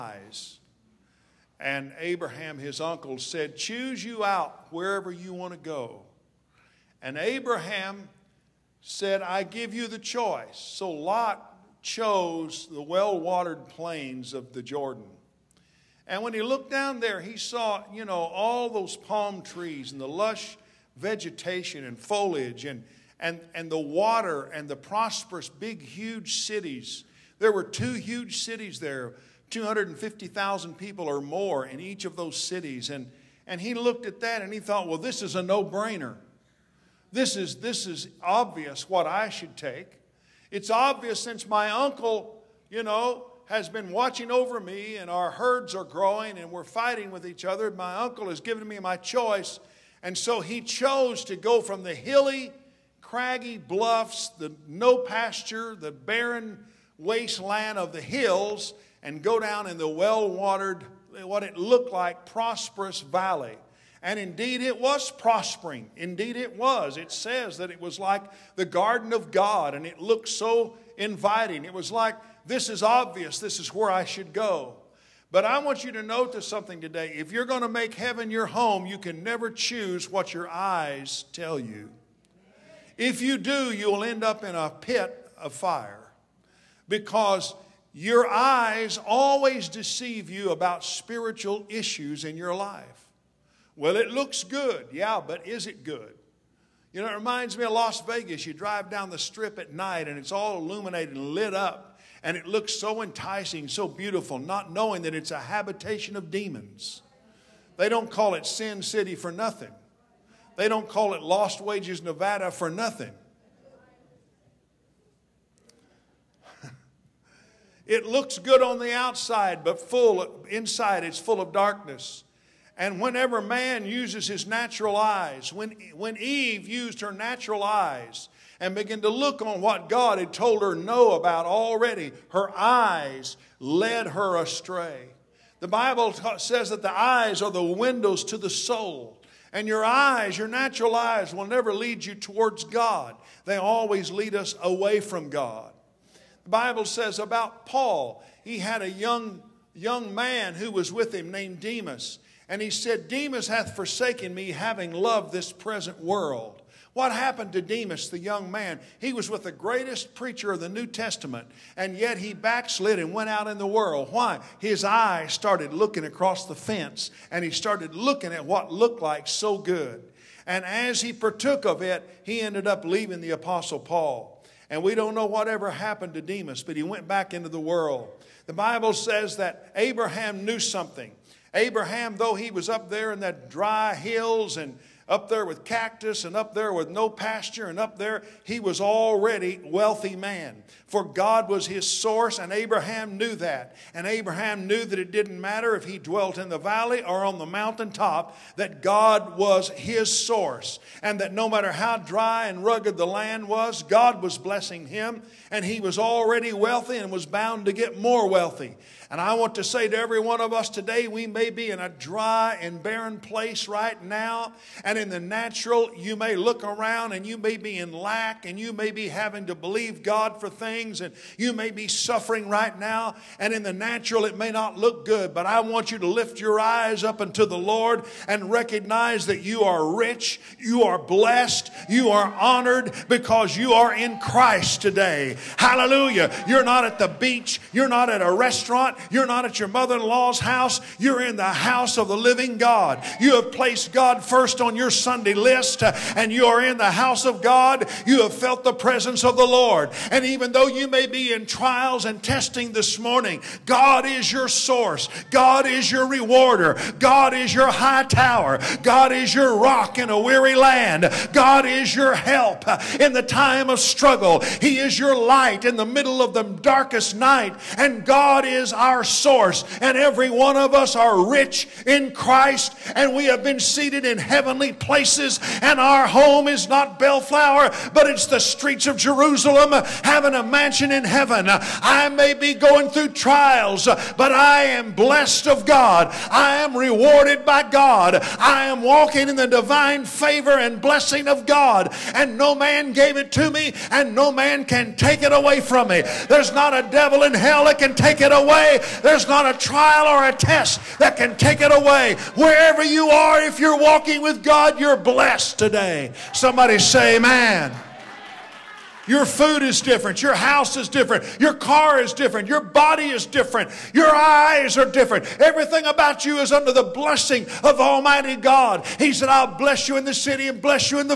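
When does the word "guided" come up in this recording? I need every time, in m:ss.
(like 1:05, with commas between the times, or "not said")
not said.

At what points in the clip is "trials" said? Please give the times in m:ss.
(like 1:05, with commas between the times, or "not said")
4:11, 4:43, 4:59.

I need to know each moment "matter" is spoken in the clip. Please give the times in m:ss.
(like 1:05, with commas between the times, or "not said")
3:15, 3:21.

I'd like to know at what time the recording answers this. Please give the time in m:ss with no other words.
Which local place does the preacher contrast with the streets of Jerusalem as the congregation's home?
4:36.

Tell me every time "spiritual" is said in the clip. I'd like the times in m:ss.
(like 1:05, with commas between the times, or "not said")
1:30.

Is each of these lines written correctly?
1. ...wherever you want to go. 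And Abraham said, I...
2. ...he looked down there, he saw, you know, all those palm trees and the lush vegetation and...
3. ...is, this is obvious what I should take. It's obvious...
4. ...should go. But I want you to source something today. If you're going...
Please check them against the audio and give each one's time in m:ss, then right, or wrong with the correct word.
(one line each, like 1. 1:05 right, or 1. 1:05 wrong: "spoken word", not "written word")
1. 0:04 right
2. 0:16 right
3. 0:37 right
4. 1:14 wrong: "notice", not "source".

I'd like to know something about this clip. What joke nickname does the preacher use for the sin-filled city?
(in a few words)
Lost Wages Nevada.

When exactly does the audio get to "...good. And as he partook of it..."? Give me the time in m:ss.
2:49.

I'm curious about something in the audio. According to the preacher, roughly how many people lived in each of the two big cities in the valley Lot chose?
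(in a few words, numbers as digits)
250,000.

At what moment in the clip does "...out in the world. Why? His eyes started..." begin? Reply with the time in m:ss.
2:43.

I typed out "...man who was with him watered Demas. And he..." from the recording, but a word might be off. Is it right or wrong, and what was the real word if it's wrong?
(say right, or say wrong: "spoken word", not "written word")
wrong: "named", not "watered".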